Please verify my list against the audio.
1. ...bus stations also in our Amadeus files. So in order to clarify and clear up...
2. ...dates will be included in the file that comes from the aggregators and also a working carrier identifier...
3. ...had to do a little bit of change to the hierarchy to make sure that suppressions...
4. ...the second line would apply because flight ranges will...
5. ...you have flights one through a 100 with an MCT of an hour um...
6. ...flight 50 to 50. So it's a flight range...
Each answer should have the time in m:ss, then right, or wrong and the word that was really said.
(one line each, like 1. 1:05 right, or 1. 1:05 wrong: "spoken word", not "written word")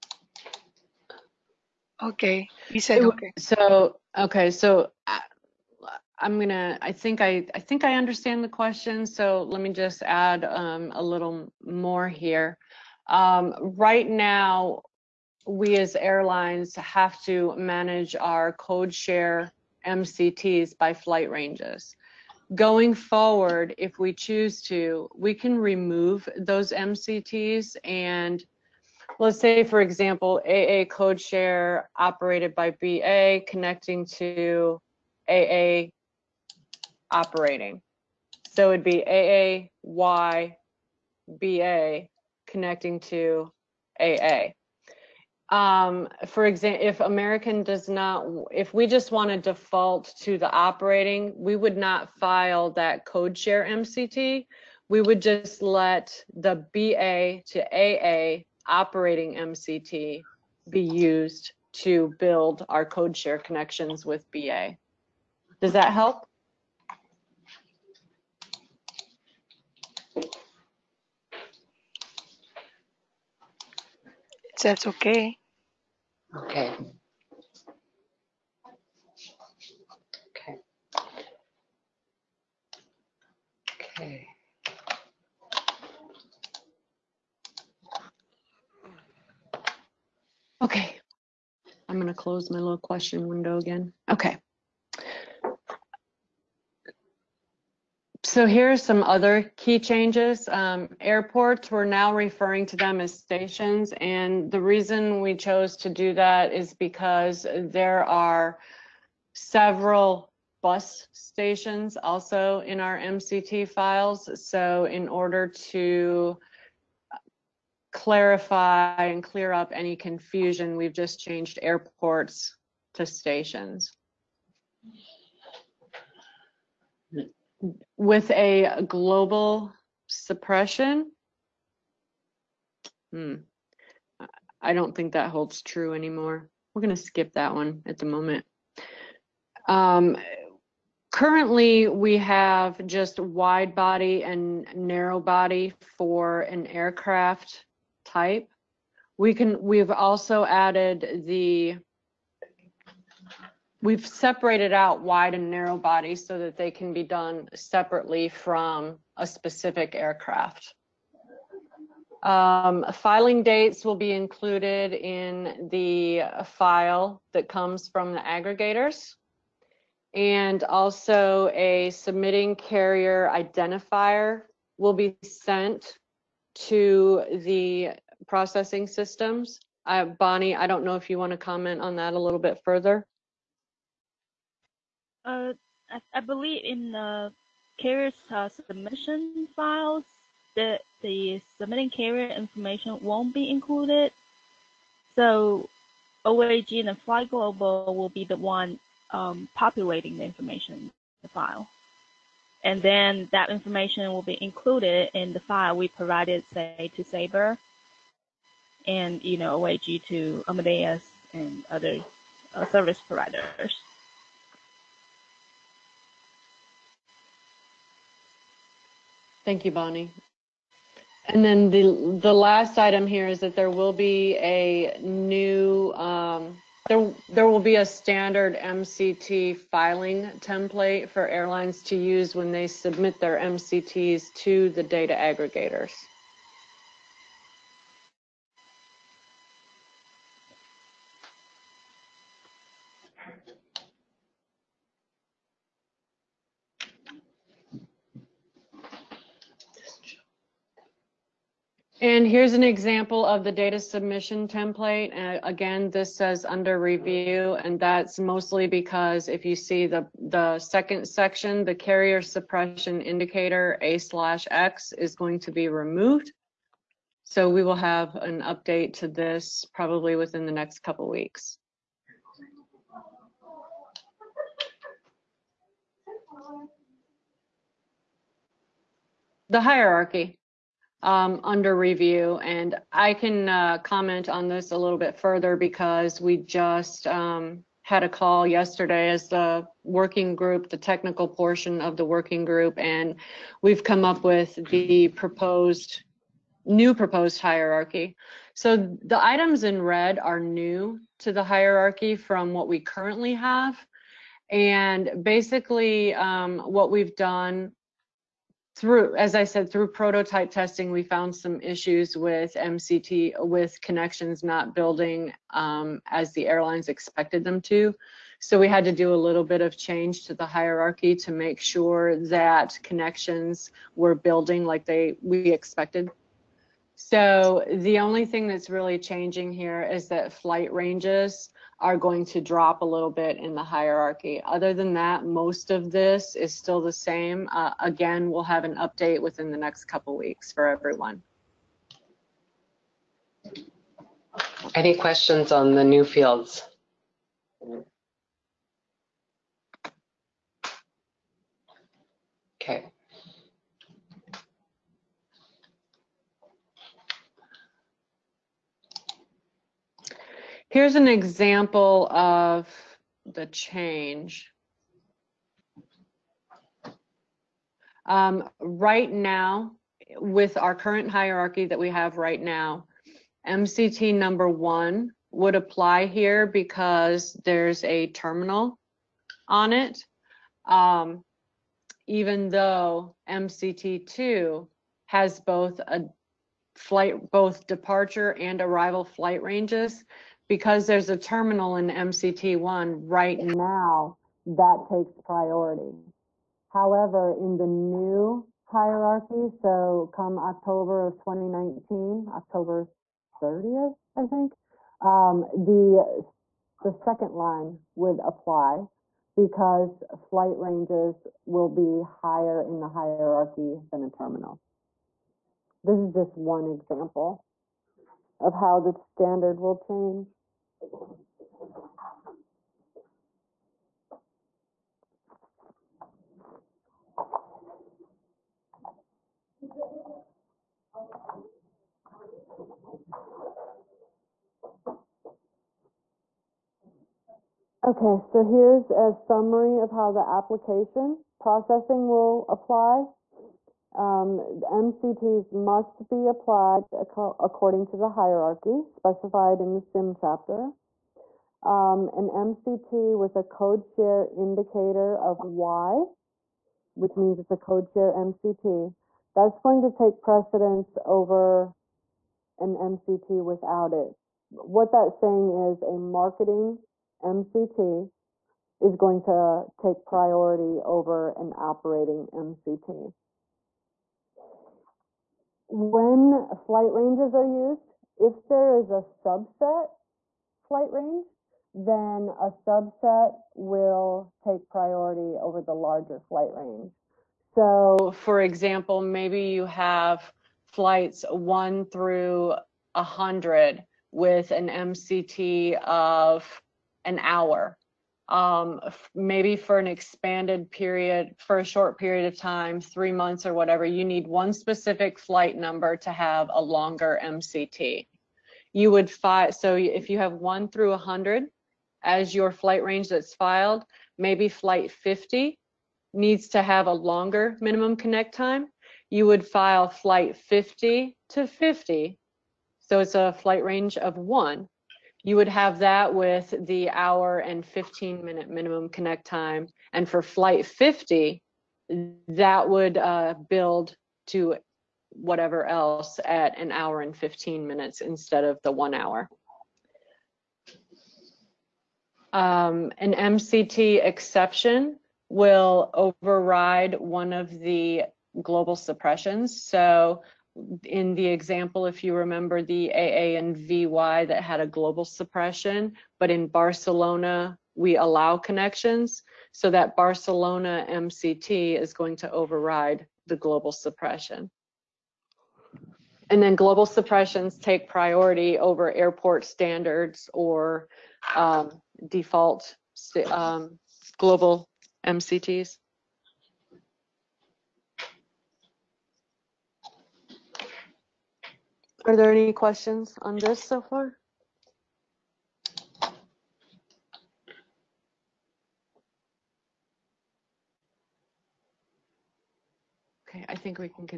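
1. 1:50 wrong: "MCT", not "Amadeus"
2. 2:43 wrong: "submitting", not "working"
3. 5:18 wrong: "connections", not "suppressions"
4. 6:46 right
5. 8:09 right
6. 8:39 right.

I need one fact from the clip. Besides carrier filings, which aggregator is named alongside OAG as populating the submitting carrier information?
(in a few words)
Flight Global.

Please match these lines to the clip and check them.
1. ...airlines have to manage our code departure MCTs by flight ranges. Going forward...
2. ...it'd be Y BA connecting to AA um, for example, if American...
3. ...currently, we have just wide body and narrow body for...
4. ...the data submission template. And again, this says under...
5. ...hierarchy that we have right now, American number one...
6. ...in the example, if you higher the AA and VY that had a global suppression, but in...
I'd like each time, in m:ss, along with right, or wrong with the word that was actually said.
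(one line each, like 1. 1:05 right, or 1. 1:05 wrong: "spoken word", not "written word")
1. 0:15 wrong: "share", not "departure"
2. 0:38 right
3. 2:21 right
4. 4:13 right
5. 6:11 wrong: "MCT", not "American"
6. 9:10 wrong: "remember", not "higher".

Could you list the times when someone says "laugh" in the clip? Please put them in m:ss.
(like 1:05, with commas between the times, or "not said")
not said.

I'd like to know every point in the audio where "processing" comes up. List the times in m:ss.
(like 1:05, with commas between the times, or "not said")
2:58, 7:21.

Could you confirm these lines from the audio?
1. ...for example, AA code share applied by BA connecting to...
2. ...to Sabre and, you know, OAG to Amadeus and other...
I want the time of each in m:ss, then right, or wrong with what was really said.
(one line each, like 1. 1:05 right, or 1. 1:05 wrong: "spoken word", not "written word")
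1. 0:29 wrong: "operated", not "applied"
2. 3:26 right.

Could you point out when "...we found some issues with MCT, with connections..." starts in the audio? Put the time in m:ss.
5:10.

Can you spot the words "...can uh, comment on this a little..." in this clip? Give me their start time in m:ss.
4:43.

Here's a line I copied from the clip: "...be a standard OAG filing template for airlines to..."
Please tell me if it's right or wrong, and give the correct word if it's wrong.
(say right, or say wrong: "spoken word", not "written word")
wrong: "MCT", not "OAG".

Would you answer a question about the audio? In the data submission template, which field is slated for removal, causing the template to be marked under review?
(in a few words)
carrier suppression indicator.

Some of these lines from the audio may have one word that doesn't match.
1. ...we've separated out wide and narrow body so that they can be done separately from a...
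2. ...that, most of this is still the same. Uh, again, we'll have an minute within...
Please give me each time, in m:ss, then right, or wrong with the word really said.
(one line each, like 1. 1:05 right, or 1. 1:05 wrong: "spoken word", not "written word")
1. 2:33 right
2. 5:34 wrong: "update", not "minute".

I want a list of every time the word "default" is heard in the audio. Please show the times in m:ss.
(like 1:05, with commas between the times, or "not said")
0:49, 9:32.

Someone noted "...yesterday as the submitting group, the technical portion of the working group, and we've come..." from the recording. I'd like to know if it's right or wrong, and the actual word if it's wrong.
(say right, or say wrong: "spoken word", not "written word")
wrong: "working", not "submitting".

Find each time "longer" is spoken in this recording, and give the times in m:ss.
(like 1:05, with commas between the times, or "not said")
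8:26, 8:36.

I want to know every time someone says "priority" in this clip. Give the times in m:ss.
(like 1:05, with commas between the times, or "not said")
6:35, 7:50, 8:04, 9:27.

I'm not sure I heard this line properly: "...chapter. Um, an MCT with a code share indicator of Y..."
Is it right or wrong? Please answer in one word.
right.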